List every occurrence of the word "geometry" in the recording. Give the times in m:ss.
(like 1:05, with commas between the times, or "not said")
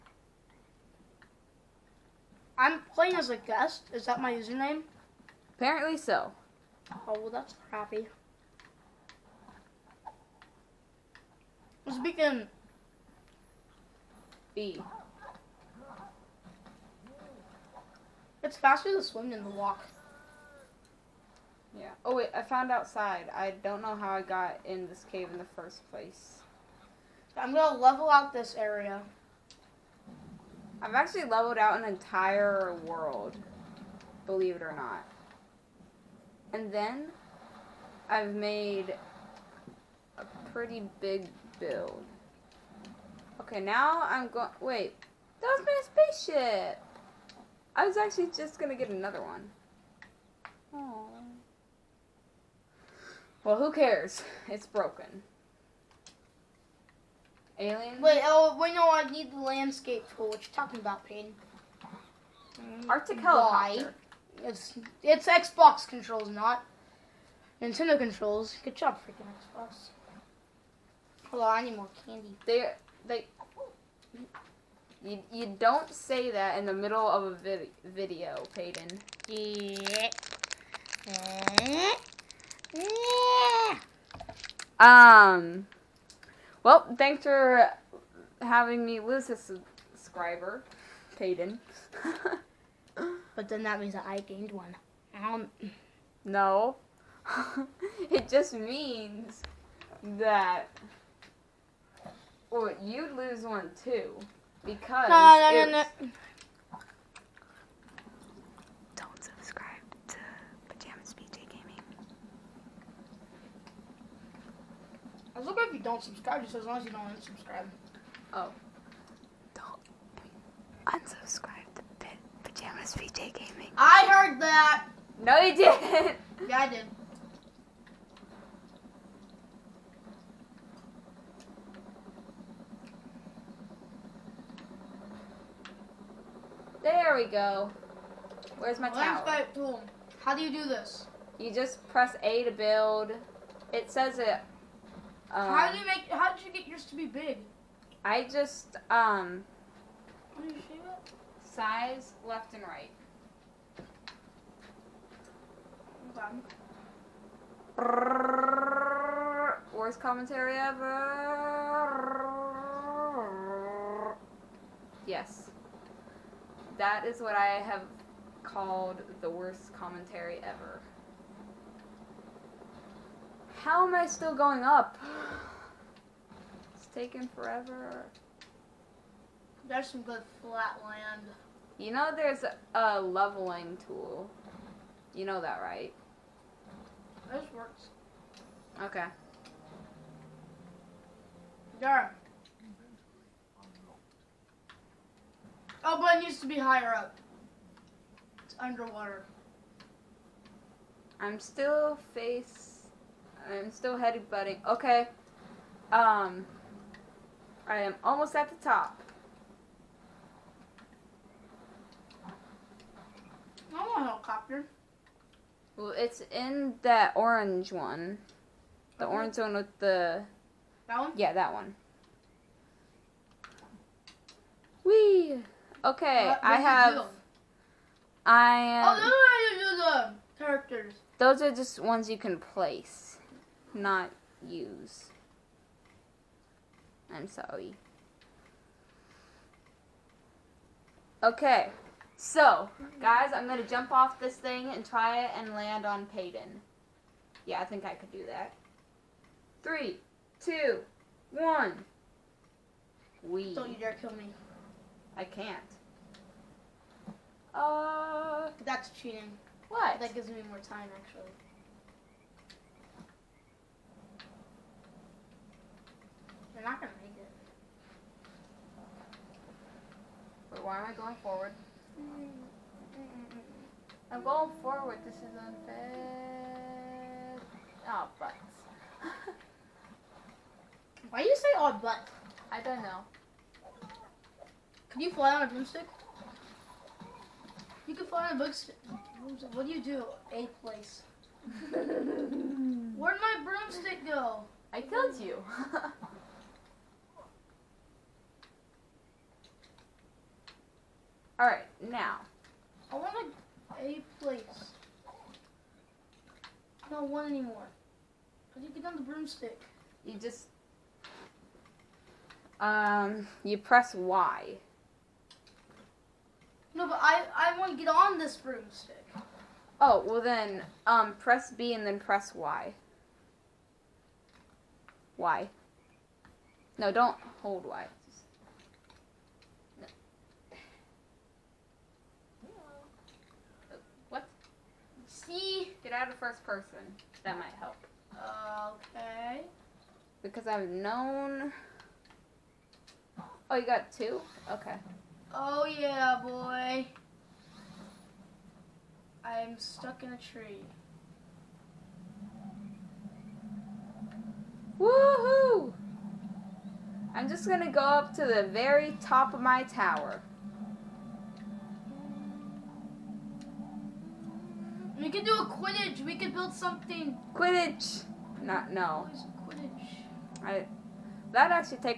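not said.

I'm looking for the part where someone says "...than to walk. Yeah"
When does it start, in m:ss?
0:19.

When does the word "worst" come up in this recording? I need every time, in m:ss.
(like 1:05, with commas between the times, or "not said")
2:39, 2:49.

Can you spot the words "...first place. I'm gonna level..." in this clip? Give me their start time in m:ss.
0:25.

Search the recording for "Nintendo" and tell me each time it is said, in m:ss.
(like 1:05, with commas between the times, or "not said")
1:07.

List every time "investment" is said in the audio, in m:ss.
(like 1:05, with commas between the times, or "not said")
not said.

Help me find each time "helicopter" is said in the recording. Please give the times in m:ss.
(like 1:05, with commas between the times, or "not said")
1:03, 3:34.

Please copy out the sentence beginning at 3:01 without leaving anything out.
You know there's a, a leveling tool.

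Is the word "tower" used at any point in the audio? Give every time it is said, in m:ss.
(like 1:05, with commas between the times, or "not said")
2:19, 5:59.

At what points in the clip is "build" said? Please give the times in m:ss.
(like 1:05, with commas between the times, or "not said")
0:41, 2:22, 6:06.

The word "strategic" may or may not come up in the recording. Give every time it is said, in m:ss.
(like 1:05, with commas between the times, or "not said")
not said.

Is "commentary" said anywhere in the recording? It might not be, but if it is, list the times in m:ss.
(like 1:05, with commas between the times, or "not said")
2:39, 2:49.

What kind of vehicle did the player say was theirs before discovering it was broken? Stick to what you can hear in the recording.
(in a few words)
Spaceship.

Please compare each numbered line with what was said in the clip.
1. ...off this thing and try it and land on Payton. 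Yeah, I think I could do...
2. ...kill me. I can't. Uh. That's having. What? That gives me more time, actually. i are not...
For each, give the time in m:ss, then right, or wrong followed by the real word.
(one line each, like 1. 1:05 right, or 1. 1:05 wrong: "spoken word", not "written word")
1. 4:03 right
2. 4:13 wrong: "cheating", not "having".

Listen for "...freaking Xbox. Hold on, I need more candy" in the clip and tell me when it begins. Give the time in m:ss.
1:09.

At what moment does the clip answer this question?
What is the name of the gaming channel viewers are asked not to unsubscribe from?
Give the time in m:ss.
2:02.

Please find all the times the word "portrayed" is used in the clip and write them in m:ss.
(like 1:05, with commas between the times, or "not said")
not said.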